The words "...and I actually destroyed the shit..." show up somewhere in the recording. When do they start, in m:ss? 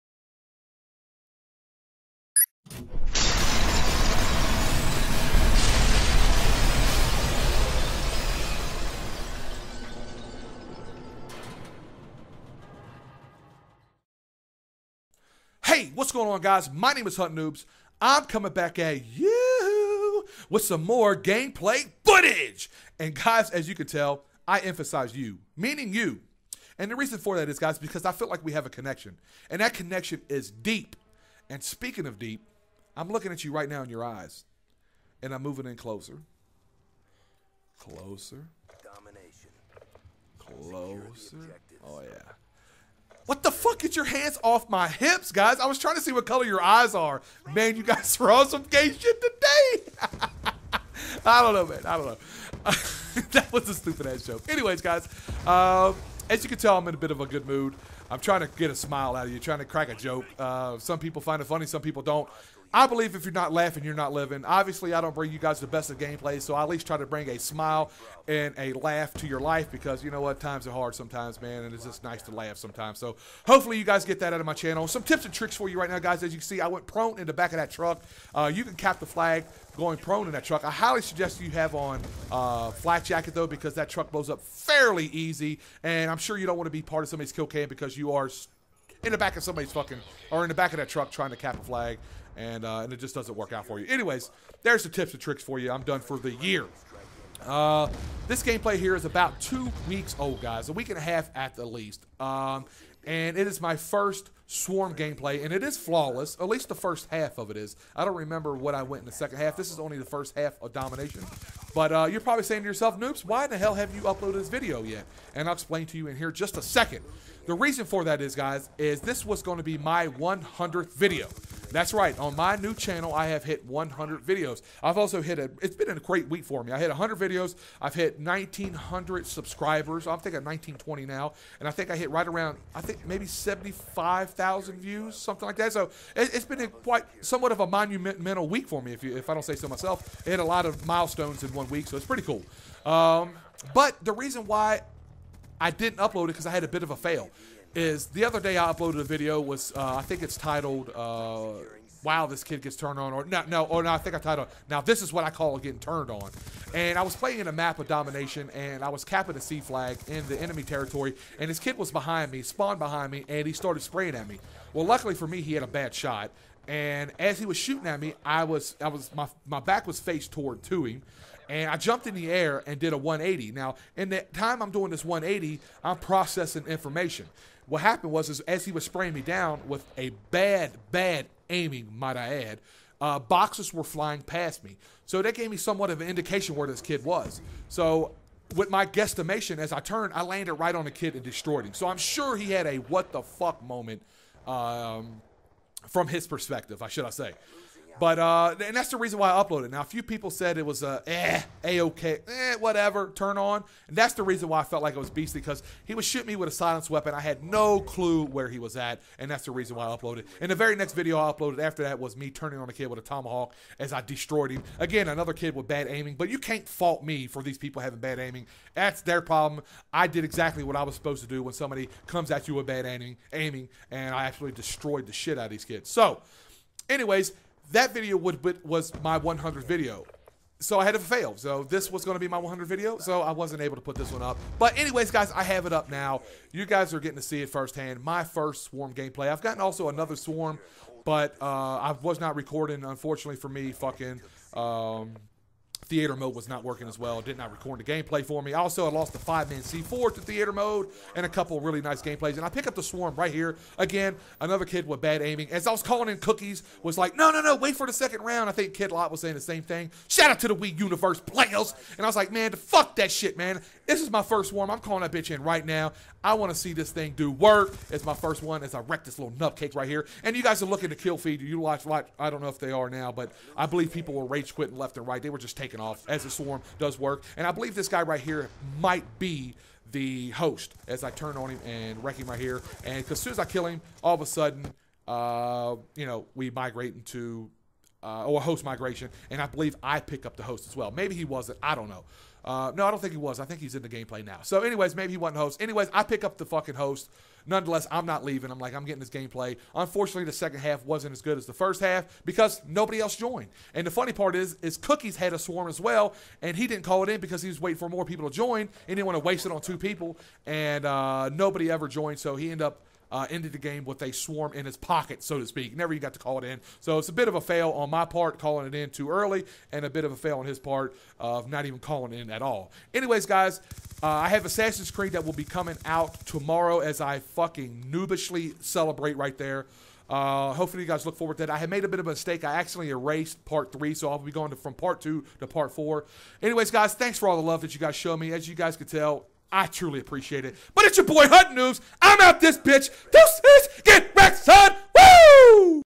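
3:43.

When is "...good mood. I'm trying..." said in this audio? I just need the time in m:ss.
0:57.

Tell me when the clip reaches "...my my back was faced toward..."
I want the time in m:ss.
2:49.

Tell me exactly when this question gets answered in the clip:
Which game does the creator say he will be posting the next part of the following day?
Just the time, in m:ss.
5:24.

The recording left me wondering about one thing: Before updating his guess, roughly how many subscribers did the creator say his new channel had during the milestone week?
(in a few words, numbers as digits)
1,900.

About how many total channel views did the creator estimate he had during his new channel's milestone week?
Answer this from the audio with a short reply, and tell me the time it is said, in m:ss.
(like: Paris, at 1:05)
75,000, at 2:13.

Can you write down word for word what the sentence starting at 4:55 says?
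Anyways, I pick up the fucking host.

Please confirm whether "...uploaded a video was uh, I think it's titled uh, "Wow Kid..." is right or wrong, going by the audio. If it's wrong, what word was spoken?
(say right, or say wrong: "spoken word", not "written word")
wrong: "This", not "Kid".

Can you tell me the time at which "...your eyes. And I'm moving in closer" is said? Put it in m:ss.
0:33.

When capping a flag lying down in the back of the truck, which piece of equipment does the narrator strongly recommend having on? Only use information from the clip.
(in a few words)
flak jacket.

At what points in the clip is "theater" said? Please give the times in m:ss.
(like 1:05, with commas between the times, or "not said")
4:05, 4:10.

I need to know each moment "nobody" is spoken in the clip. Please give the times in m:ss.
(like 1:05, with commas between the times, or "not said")
5:02, 5:11.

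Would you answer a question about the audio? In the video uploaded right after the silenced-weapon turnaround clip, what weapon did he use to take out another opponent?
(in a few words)
tomahawk.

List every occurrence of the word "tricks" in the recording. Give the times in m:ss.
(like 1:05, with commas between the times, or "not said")
1:15, 1:35.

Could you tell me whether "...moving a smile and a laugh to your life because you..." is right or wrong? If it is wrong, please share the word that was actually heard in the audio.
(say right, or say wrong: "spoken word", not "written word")
wrong: "bring", not "moving".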